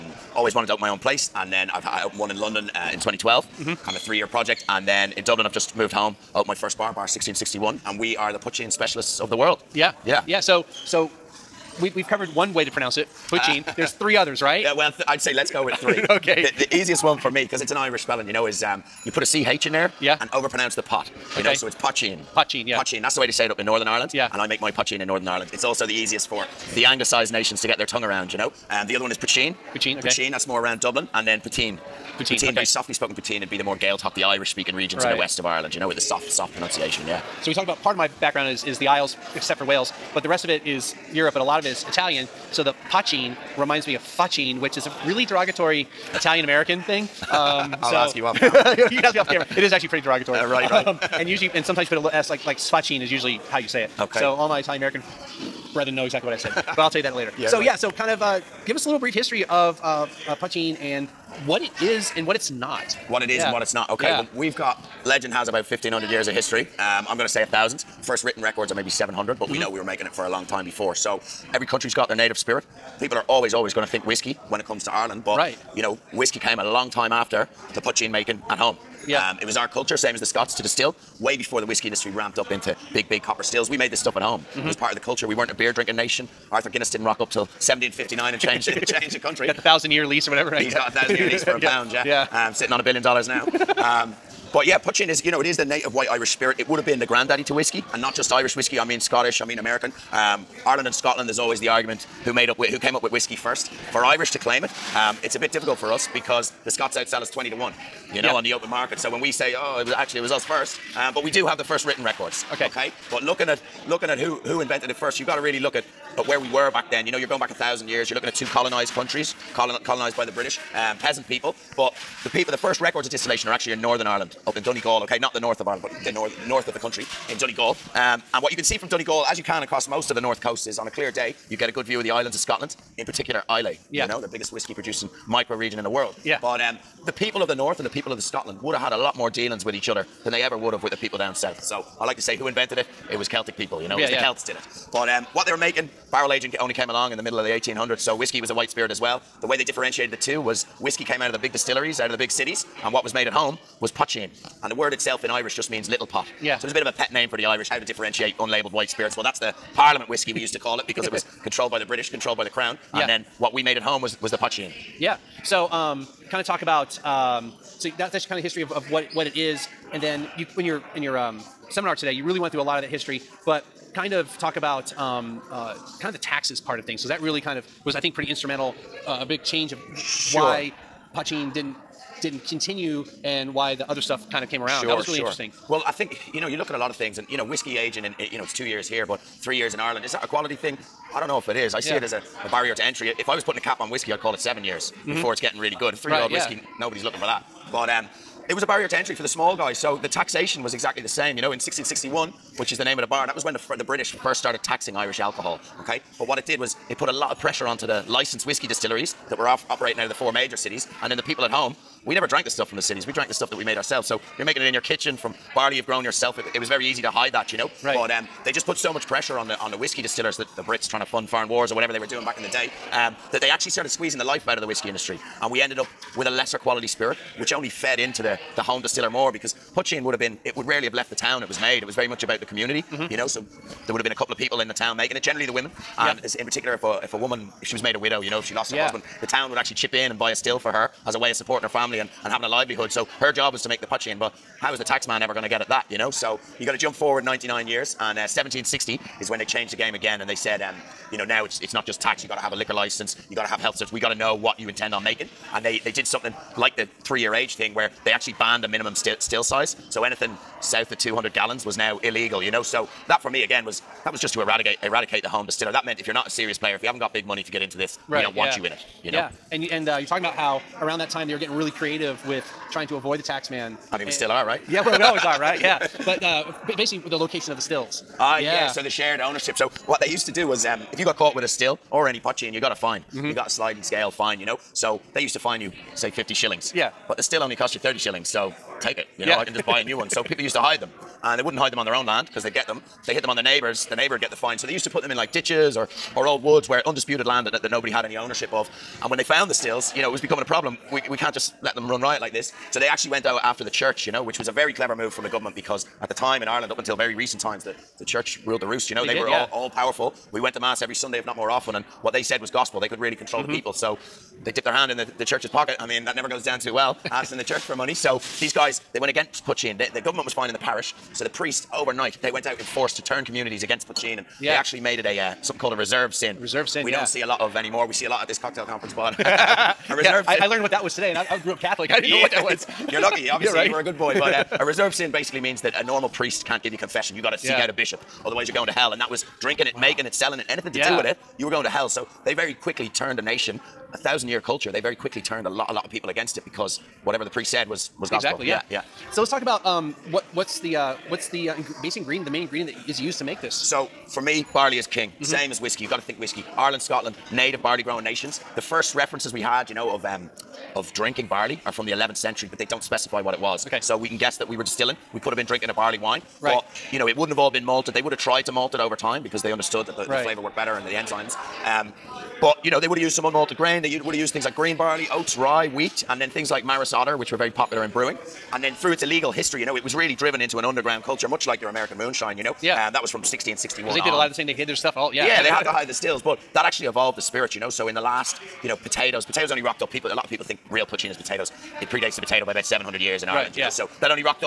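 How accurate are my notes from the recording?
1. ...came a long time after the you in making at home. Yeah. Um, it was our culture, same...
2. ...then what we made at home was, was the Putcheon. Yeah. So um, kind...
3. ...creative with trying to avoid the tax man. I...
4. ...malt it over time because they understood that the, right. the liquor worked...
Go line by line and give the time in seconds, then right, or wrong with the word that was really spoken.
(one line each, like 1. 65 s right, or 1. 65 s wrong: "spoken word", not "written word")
1. 76 s right
2. 163 s right
3. 271 s right
4. 368 s wrong: "flavor", not "liquor".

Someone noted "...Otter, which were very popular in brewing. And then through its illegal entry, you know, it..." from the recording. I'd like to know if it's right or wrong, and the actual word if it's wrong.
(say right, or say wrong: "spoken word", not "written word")
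wrong: "history", not "entry".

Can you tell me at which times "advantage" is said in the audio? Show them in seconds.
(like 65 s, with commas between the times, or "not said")
not said.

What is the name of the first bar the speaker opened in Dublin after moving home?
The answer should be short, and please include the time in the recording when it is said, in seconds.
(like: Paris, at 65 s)
Bar 1661, at 6 s.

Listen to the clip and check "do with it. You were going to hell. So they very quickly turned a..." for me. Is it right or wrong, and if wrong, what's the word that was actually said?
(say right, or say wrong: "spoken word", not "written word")
right.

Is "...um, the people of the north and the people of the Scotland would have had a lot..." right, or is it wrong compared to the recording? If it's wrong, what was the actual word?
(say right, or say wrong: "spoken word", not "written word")
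right.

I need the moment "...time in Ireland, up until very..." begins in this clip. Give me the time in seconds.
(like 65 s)
306 s.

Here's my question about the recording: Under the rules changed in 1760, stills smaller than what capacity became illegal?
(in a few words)
200 gallons.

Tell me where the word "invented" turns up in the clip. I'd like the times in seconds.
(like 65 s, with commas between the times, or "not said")
114 s, 142 s.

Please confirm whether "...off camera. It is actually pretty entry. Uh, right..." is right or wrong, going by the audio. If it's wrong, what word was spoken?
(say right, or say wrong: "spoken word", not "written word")
wrong: "derogatory", not "entry".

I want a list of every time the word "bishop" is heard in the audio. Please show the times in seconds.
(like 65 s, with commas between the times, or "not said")
337 s.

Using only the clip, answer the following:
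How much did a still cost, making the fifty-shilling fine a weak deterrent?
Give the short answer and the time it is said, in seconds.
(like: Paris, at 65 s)
30 shillings, at 287 s.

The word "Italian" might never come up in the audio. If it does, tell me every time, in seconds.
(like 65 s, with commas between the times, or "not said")
41 s, 46 s, 54 s.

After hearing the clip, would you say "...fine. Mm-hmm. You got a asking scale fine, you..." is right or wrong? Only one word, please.
wrong.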